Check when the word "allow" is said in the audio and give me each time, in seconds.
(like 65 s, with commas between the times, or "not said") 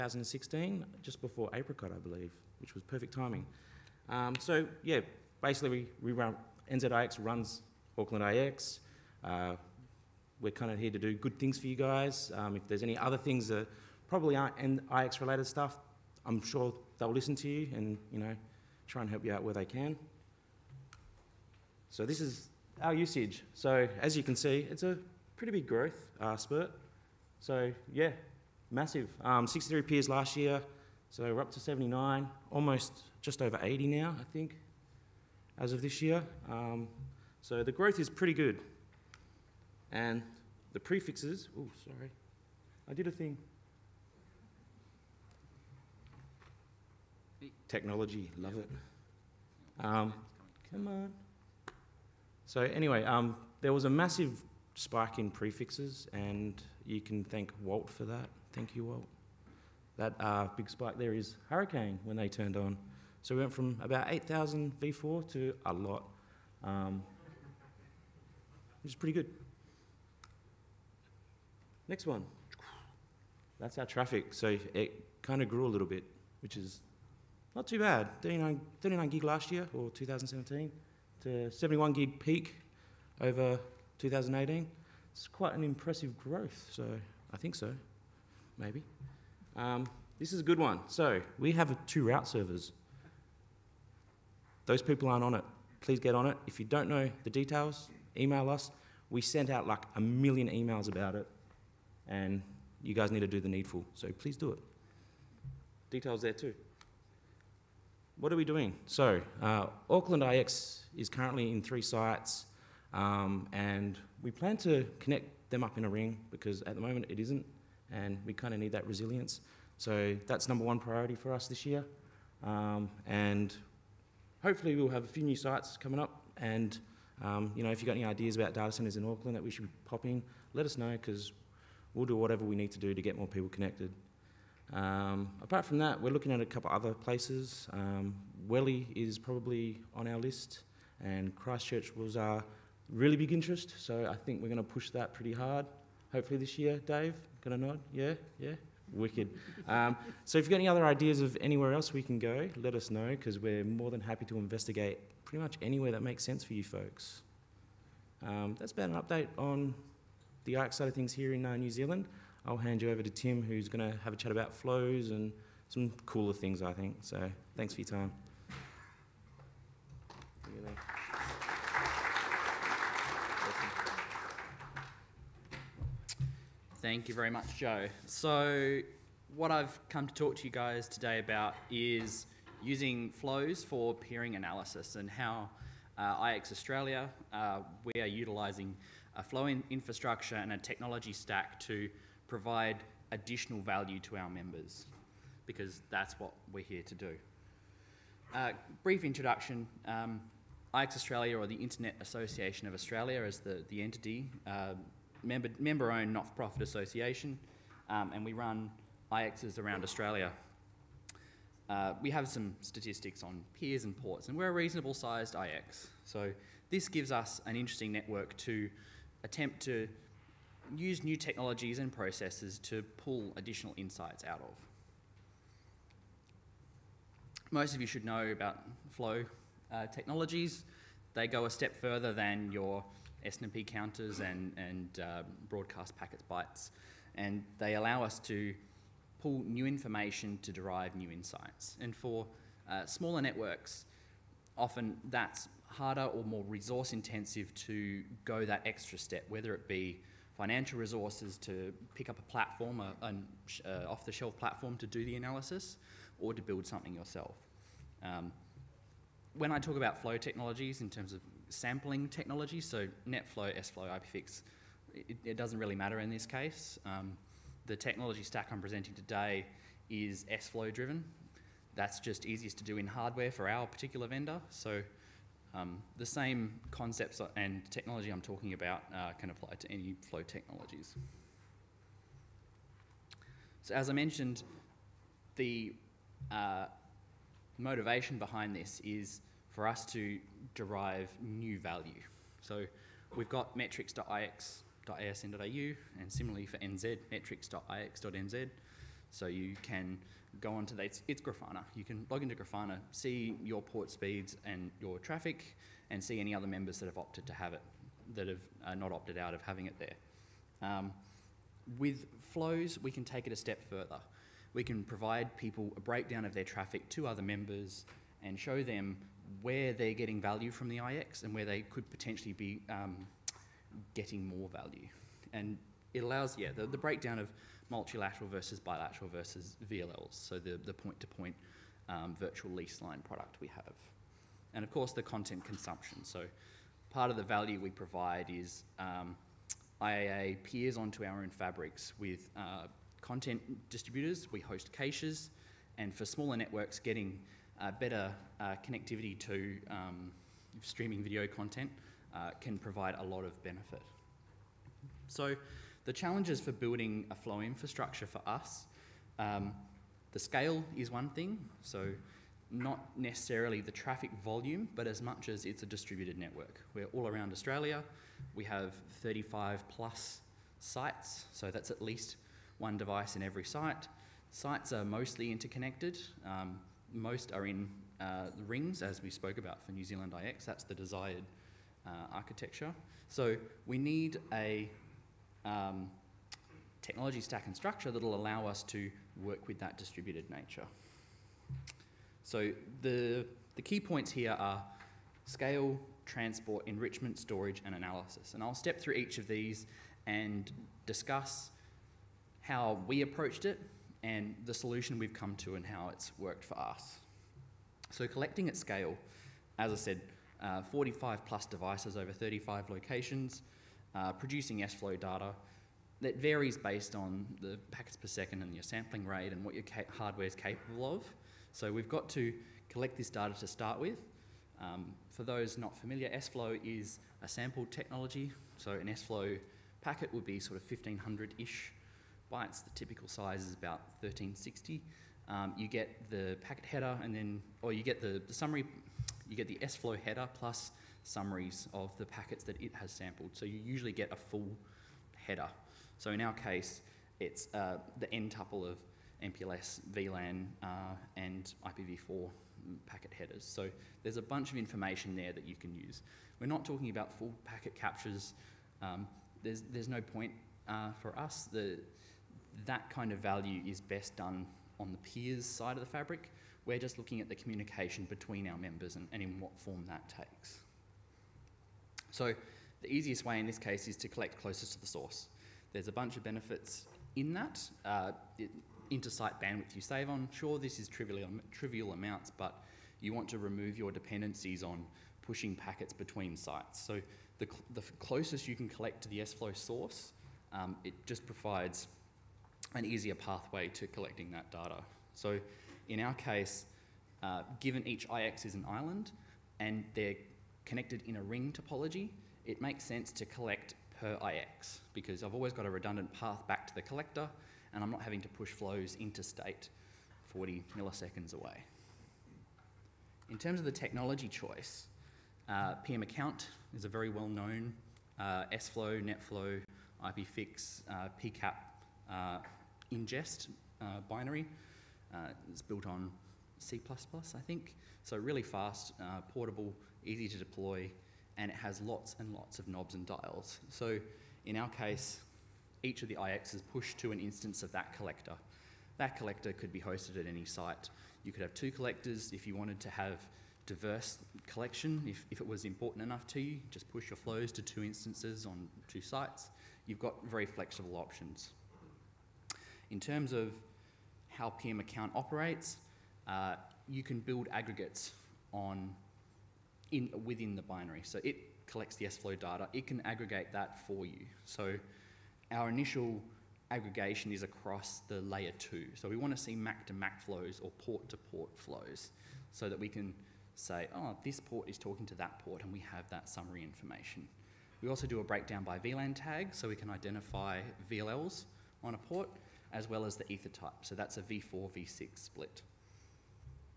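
237 s, 326 s, 388 s.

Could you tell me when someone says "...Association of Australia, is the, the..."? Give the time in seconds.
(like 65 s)
202 s.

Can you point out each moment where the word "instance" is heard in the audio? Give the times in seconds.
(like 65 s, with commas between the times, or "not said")
537 s, 547 s.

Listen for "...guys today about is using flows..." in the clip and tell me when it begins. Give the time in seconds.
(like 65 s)
180 s.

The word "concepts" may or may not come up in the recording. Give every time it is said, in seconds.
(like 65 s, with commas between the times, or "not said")
276 s.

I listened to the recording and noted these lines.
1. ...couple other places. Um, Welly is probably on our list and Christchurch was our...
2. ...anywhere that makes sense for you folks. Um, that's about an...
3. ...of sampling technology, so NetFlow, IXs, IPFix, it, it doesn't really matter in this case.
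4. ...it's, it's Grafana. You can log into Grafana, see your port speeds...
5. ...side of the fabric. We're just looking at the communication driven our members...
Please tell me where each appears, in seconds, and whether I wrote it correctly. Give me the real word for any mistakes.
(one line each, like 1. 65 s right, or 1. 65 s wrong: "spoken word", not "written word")
1. 136 s right
2. 155 s right
3. 261 s wrong: "SFlow", not "IXs"
4. 300 s right
5. 465 s wrong: "between", not "driven".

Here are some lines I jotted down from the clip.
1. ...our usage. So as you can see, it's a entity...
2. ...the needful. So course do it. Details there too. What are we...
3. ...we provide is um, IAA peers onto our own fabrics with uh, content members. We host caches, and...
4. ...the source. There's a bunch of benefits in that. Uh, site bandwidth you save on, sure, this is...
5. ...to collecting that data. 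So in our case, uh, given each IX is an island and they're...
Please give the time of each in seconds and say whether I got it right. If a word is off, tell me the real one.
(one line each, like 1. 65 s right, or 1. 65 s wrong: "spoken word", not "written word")
1. 22 s wrong: "pretty", not "entity"
2. 103 s wrong: "please", not "course"
3. 337 s wrong: "distributors", not "members"
4. 474 s right
5. 493 s right.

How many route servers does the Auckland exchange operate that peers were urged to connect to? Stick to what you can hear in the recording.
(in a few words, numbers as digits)
2.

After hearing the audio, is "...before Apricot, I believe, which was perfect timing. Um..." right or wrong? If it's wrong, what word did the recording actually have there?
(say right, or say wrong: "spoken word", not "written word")
right.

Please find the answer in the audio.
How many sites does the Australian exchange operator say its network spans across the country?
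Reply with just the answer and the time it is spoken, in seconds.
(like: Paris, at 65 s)
35 plus, at 369 s.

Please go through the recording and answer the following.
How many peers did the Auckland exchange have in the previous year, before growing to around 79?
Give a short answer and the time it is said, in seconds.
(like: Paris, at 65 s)
63, at 29 s.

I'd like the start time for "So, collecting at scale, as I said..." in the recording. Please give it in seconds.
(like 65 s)
407 s.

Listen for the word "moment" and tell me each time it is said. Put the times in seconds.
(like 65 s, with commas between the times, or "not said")
116 s.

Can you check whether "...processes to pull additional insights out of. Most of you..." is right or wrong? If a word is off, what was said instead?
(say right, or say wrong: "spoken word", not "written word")
right.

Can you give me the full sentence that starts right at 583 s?
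So that's a V4, V6 split.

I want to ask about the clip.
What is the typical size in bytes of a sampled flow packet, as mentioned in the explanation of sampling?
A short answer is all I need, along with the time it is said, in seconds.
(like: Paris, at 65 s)
1360, at 434 s.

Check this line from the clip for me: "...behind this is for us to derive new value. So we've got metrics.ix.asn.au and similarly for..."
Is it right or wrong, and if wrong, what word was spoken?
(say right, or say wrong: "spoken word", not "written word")
right.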